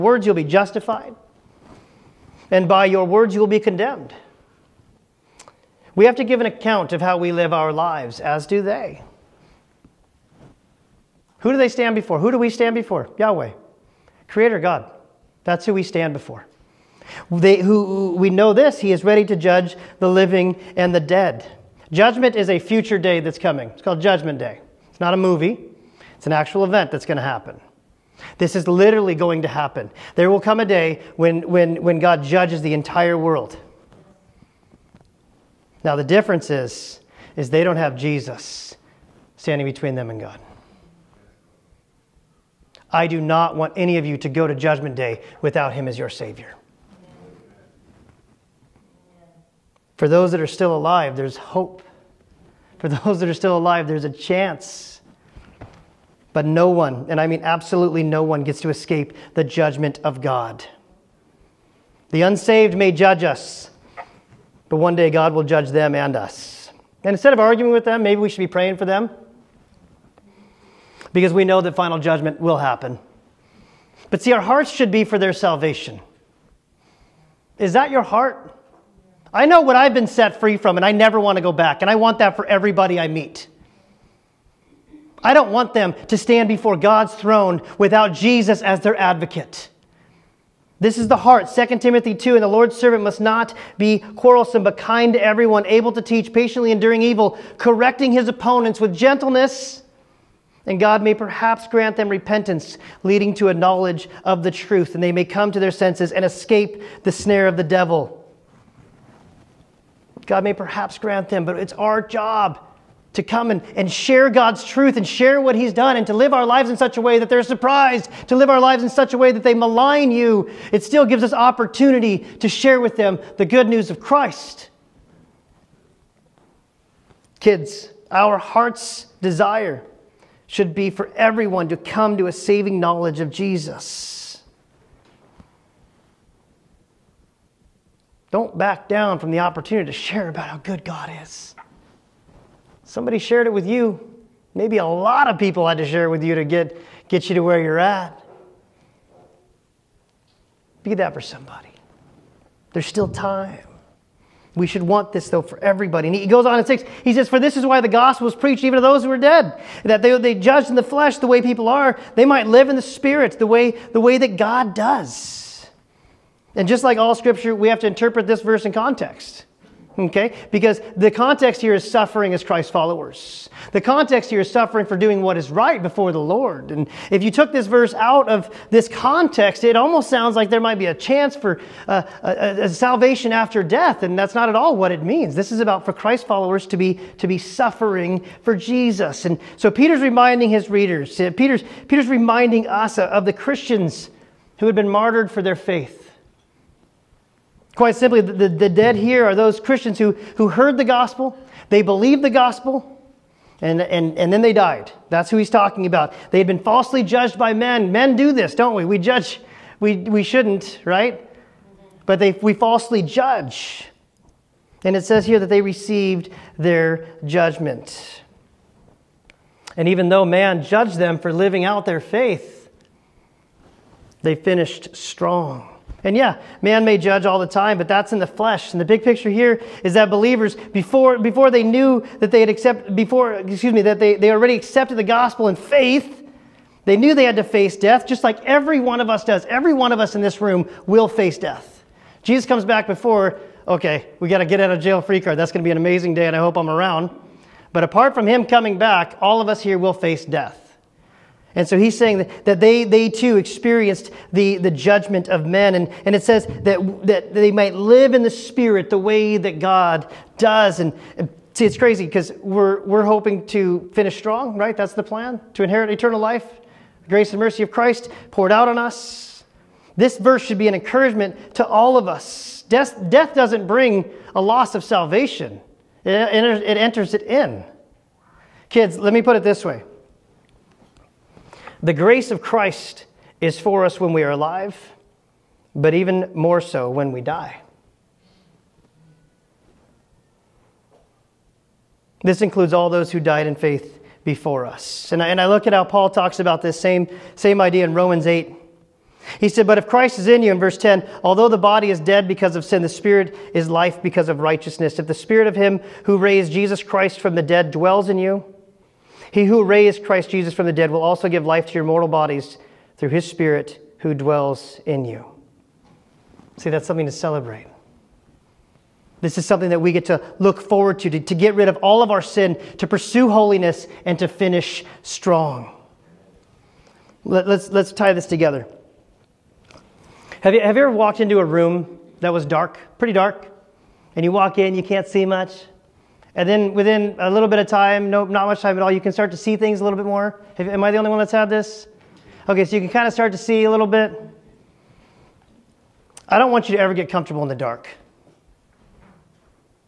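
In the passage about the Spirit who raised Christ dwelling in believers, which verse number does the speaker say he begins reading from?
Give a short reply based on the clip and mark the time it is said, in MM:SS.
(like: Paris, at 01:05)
10, at 05:00.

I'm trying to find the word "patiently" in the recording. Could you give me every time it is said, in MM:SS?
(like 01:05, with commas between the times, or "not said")
01:36.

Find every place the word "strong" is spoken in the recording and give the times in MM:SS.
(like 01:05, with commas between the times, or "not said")
03:44, 04:24, 05:25.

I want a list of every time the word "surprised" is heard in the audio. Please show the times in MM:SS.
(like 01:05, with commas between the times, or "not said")
01:57.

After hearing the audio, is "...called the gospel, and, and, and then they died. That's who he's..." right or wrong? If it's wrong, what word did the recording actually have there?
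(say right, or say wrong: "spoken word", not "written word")
wrong: "believed", not "called".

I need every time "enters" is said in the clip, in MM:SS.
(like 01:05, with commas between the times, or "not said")
04:36.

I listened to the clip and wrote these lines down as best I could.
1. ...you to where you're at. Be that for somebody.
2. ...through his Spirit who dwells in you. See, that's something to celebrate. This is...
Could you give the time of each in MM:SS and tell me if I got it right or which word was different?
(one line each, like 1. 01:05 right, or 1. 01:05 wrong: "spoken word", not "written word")
1. 02:27 right
2. 05:12 right.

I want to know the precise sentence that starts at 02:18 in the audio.
Don't back down from the opportunity to share about how good God is.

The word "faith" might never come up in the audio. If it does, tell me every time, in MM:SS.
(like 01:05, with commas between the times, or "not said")
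03:15, 03:41, 03:55, 04:53.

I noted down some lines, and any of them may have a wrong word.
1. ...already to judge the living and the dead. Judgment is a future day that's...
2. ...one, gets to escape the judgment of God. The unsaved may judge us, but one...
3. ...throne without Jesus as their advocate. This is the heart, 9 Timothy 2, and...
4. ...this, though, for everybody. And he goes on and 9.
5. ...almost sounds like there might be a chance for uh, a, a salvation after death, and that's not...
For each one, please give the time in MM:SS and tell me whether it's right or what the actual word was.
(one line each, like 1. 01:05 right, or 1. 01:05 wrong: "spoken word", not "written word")
1. 00:19 wrong: "ready", not "already"
2. 00:58 right
3. 01:27 wrong: "2", not "9"
4. 02:35 wrong: "6", not "9"
5. 02:59 right.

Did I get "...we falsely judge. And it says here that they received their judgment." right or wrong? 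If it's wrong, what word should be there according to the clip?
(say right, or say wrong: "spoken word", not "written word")
right.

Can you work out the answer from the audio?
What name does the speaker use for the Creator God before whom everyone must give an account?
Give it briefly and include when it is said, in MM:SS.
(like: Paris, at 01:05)
Yahweh, at 00:13.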